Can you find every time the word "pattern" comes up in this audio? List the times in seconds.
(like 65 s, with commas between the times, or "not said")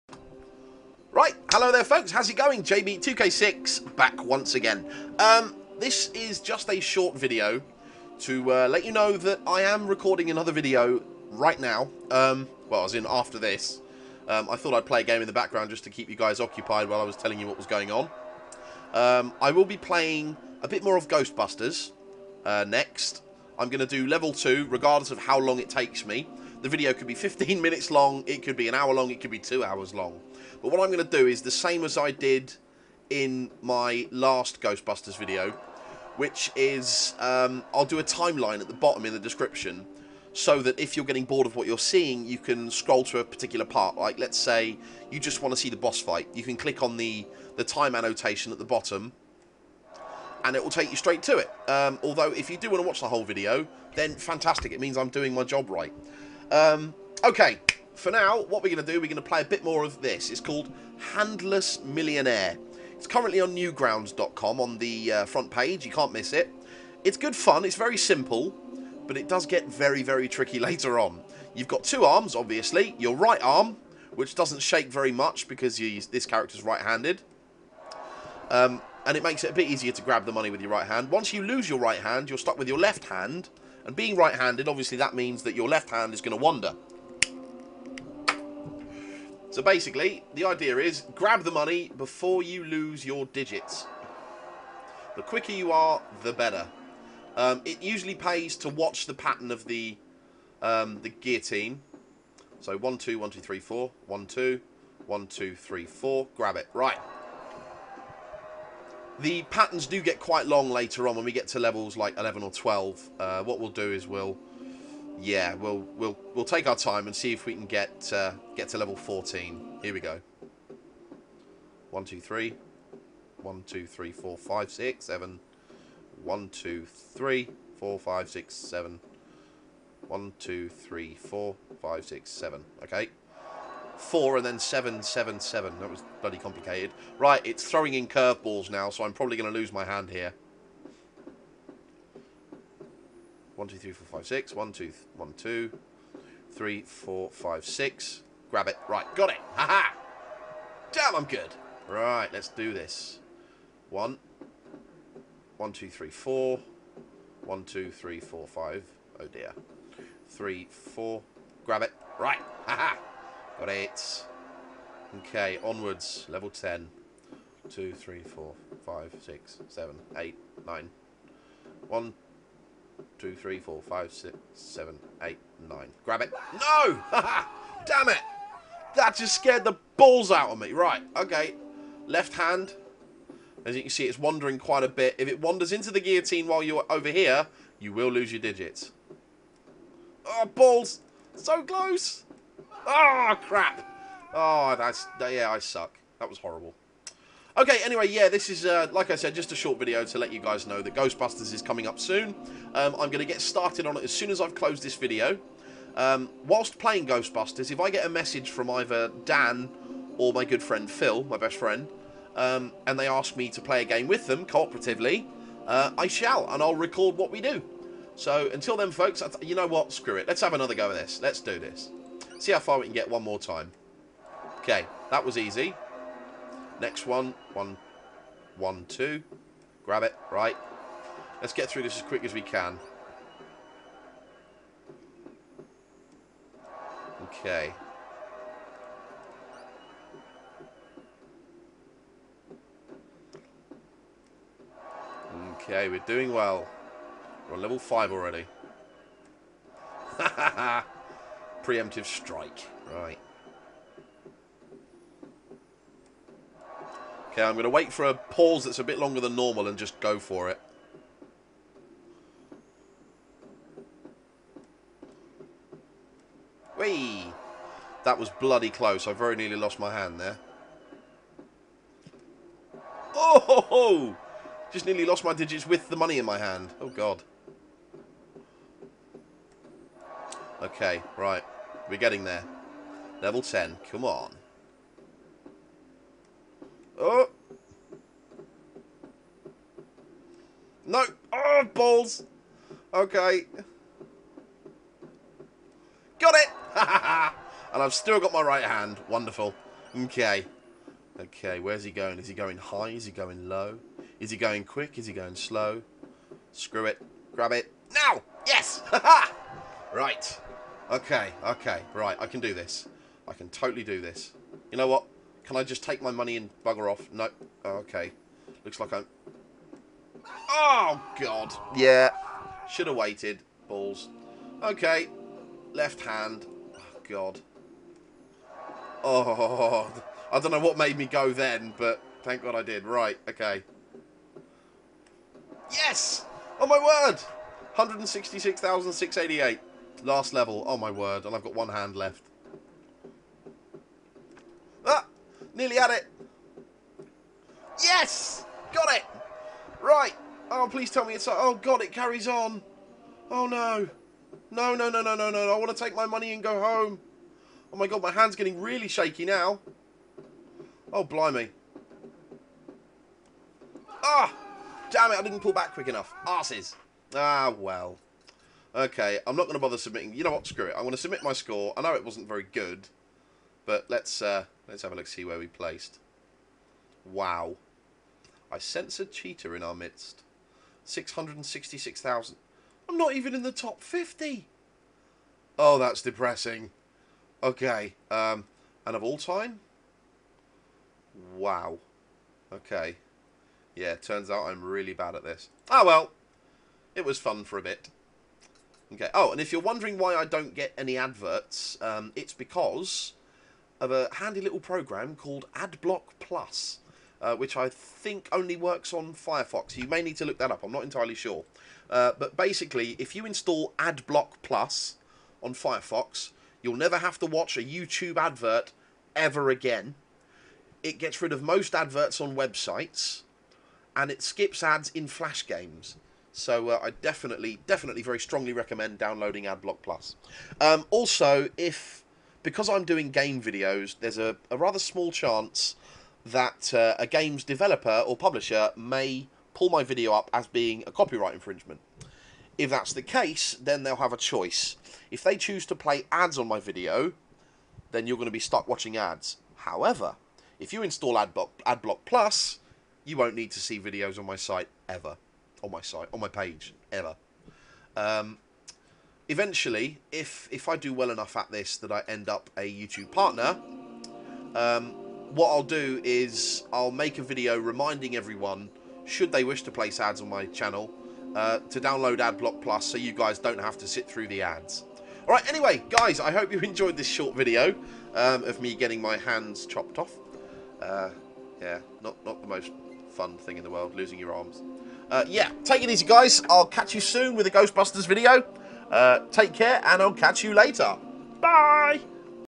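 99 s, 109 s.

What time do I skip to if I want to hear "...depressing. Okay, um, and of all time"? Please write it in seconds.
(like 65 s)
386 s.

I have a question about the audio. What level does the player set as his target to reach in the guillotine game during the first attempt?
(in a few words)
14.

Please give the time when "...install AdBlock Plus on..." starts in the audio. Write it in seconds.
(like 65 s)
413 s.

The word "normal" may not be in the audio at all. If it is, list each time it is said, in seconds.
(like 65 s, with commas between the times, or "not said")
259 s.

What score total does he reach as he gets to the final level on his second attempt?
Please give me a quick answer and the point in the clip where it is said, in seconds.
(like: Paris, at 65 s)
166,688, at 337 s.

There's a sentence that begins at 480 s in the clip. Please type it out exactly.
Uh, yeah, not, not the most fun thing in the world, losing your arms.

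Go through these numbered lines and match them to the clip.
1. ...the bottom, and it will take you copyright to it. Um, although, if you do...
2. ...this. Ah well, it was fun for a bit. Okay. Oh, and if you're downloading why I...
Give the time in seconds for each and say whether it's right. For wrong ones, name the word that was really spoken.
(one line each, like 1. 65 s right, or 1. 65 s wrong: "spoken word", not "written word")
1. 48 s wrong: "straight", not "copyright"
2. 395 s wrong: "wondering", not "downloading".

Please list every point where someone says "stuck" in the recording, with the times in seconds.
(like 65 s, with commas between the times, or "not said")
82 s, 448 s.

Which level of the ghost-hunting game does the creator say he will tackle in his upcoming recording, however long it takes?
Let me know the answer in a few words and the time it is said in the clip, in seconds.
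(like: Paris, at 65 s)
Level 2, at 24 s.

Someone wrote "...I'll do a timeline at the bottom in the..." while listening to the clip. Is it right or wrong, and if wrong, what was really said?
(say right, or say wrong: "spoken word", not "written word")
right.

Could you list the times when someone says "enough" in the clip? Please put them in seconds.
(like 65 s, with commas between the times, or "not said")
365 s, 461 s.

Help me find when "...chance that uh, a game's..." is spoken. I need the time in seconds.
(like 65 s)
435 s.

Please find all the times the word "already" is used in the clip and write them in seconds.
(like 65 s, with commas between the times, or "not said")
248 s.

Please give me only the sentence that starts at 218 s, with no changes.
So until then, folks, you know what?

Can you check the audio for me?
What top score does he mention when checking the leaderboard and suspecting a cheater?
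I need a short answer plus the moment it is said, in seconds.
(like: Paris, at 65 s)
666,000, at 380 s.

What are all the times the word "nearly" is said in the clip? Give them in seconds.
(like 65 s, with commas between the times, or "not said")
269 s, 274 s, 345 s.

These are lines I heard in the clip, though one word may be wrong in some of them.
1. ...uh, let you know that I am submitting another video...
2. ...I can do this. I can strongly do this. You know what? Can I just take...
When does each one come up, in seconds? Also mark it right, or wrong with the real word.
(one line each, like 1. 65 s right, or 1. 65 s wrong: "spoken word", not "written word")
1. 8 s wrong: "recording", not "submitting"
2. 312 s wrong: "totally", not "strongly".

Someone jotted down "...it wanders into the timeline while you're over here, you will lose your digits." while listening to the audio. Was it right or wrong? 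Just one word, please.
wrong.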